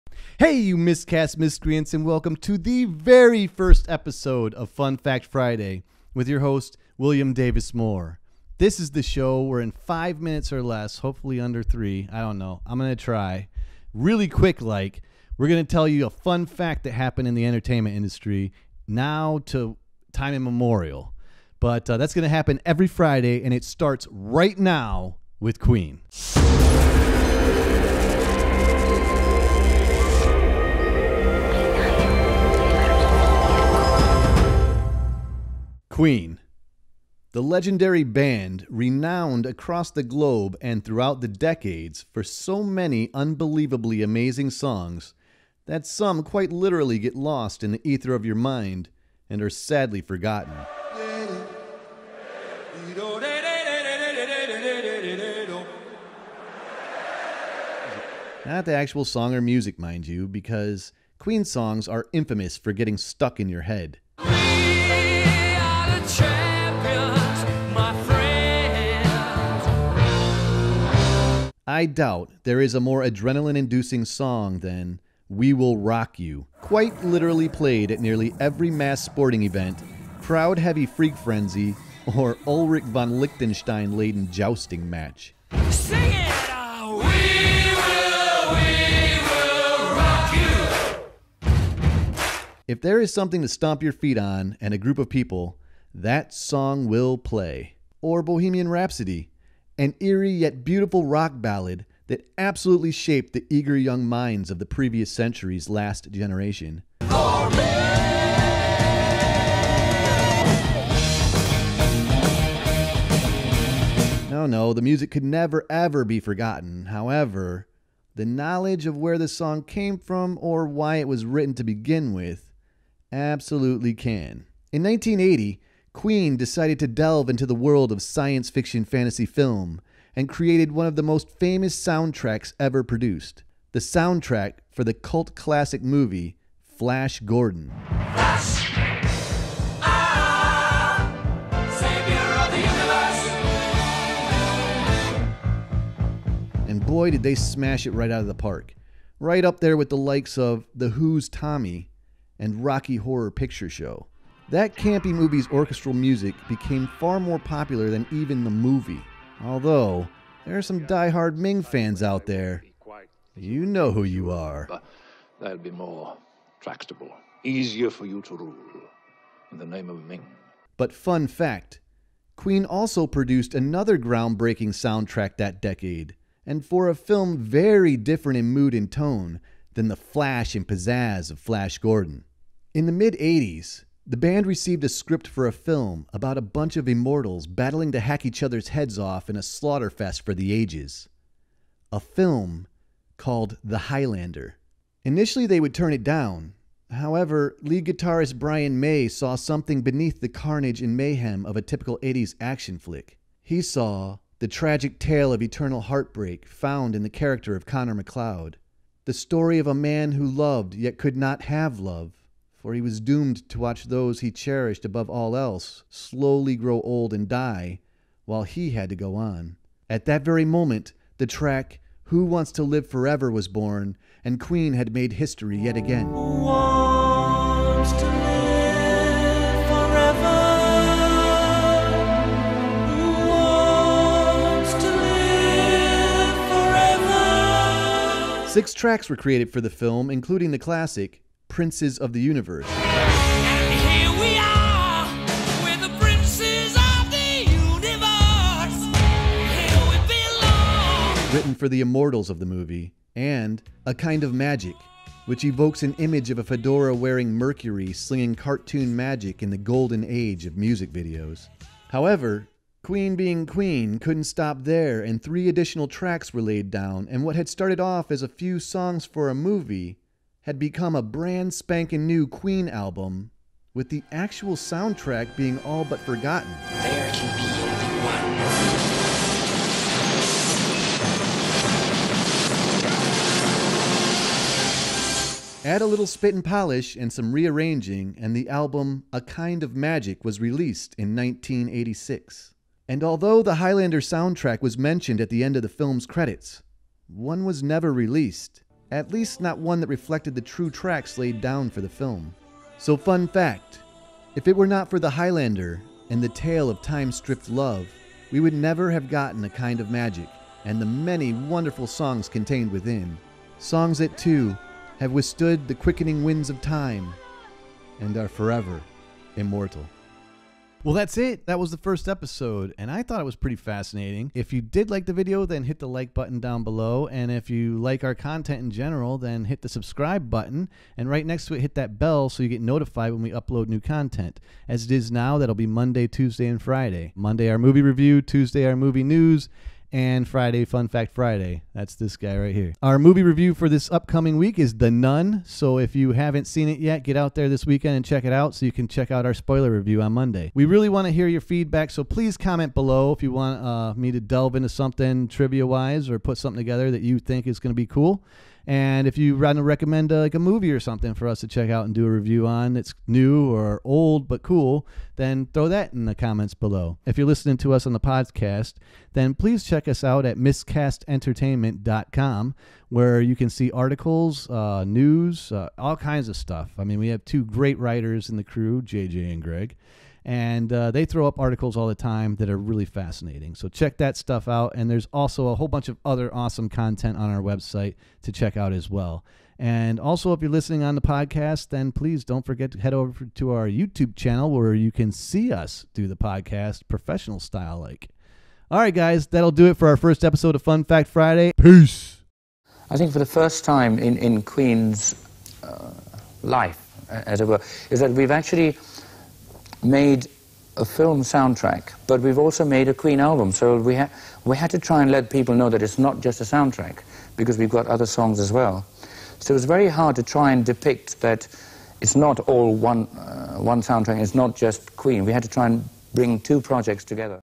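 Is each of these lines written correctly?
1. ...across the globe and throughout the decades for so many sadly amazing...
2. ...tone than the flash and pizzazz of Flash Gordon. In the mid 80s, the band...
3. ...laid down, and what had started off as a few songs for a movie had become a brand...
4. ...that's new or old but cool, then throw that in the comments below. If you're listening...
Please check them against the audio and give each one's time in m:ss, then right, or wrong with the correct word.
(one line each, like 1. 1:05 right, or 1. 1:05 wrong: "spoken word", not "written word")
1. 0:39 wrong: "unbelievably", not "sadly"
2. 2:58 right
3. 4:26 right
4. 6:02 right.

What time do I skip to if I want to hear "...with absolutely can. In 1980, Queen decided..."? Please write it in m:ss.
2:02.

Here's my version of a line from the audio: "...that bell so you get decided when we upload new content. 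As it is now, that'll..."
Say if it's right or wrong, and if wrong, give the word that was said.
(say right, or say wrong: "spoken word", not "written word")
wrong: "notified", not "decided".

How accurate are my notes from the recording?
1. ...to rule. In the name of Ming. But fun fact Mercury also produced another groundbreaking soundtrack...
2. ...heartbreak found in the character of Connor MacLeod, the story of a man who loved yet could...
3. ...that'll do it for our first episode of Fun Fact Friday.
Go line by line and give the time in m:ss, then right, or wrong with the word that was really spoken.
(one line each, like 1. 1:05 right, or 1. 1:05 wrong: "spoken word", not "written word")
1. 2:48 wrong: "Queen", not "Mercury"
2. 3:25 right
3. 6:39 right.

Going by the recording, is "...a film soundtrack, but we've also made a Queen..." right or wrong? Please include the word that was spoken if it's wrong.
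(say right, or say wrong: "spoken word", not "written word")
right.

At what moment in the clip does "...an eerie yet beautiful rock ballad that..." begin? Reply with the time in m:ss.
1:39.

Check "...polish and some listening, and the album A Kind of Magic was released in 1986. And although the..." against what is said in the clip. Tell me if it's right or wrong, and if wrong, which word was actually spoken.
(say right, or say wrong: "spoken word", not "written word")
wrong: "rearranging", not "listening".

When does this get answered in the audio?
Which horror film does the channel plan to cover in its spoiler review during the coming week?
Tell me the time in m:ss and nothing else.
5:44.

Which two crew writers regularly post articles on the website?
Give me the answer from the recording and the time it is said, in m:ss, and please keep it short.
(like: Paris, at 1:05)
JJ and Greg, at 6:18.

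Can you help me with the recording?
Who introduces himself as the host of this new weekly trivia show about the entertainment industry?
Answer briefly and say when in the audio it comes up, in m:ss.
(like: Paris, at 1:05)
William Davis Moore, at 0:06.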